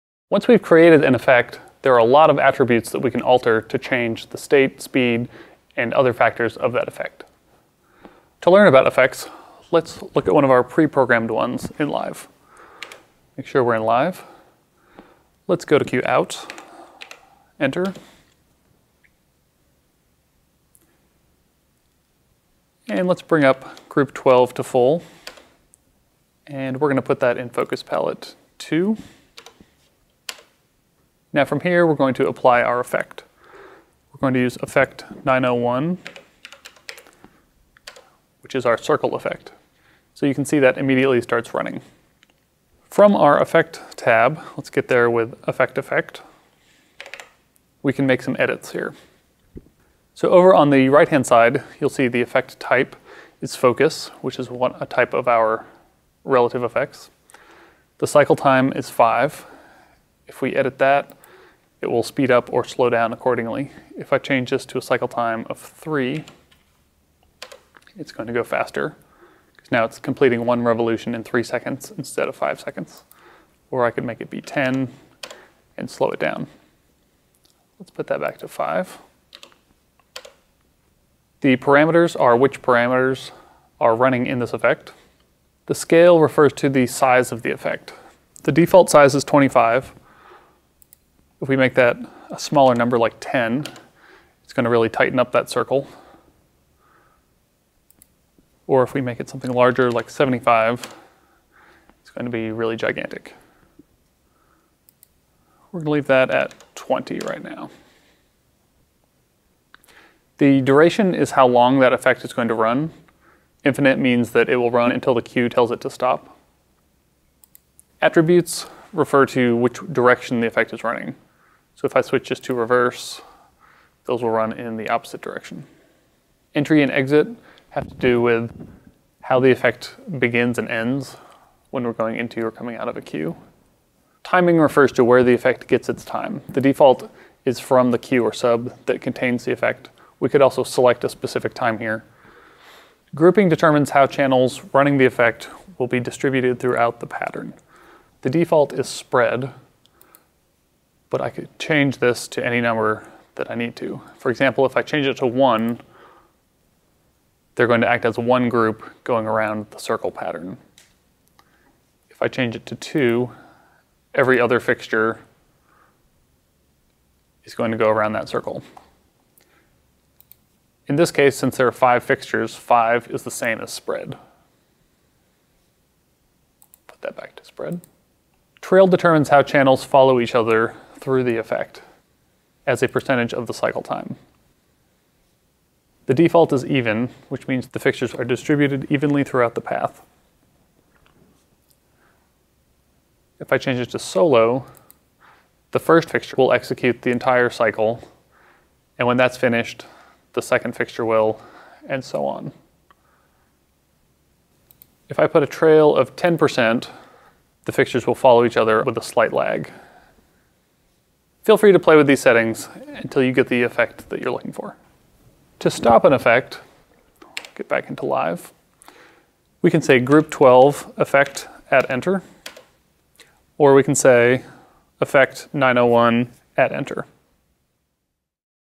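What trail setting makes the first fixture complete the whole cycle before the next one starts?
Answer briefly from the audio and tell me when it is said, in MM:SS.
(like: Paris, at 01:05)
solo, at 03:13.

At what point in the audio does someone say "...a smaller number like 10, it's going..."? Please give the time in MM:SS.
01:32.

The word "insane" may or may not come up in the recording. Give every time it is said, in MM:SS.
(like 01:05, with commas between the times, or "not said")
not said.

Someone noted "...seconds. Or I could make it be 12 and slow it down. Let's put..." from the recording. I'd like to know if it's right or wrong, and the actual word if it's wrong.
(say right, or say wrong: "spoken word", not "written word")
wrong: "10", not "12".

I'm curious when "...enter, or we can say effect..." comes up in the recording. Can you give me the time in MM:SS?
03:41.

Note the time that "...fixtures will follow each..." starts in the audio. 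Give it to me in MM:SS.
03:27.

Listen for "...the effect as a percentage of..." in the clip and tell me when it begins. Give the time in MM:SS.
03:01.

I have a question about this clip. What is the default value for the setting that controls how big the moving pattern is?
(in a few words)
25.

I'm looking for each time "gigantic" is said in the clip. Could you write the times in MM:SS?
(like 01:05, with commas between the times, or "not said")
01:42.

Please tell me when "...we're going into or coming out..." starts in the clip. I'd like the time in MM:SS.
02:11.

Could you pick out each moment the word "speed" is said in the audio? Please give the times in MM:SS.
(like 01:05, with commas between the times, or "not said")
00:04, 01:02.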